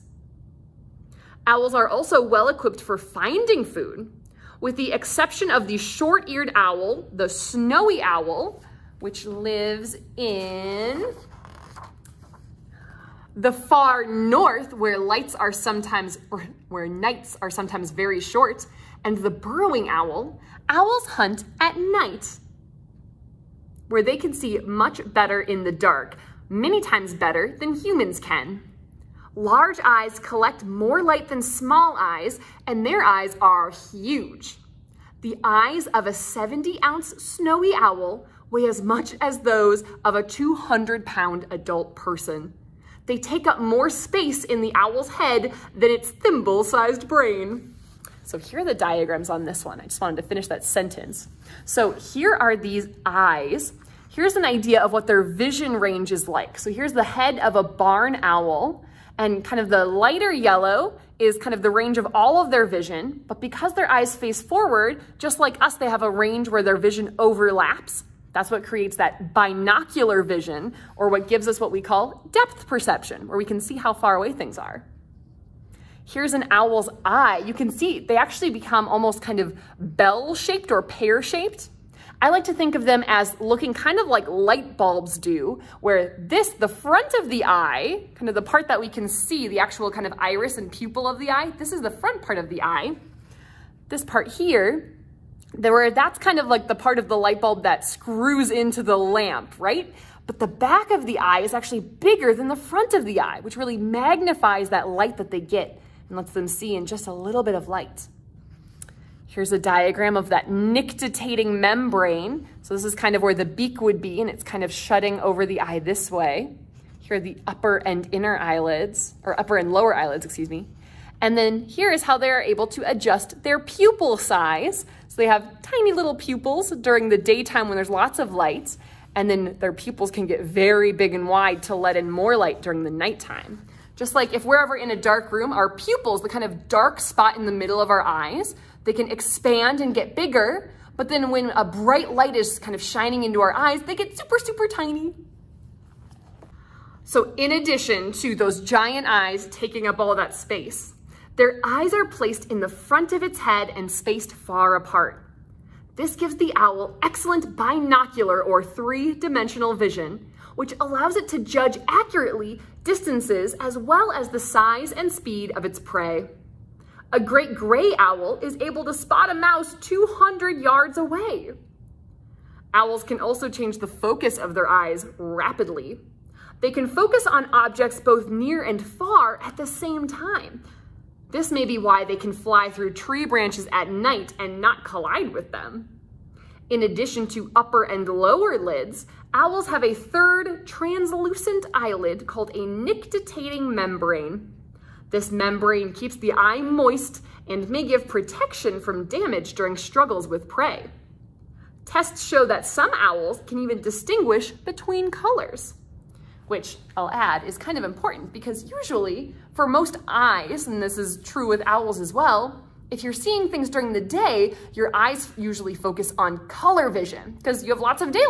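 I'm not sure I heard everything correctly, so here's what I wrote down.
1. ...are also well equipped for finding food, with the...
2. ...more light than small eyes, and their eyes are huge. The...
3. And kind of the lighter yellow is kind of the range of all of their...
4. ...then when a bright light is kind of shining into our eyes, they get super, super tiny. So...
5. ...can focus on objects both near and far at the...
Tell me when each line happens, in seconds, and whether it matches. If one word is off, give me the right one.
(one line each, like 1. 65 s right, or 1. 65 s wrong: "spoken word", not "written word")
1. 1 s right
2. 30 s right
3. 59 s right
4. 141 s right
5. 176 s right.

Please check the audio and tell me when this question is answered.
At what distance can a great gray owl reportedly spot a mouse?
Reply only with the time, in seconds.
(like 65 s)
169 s.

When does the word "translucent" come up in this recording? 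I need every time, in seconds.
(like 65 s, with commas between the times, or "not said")
190 s.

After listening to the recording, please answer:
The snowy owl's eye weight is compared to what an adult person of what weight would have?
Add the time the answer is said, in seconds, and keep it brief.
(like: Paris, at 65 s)
200 pounds, at 40 s.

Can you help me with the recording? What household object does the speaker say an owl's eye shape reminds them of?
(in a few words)
Light bulbs.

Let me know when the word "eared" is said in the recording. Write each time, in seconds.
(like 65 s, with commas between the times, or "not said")
5 s.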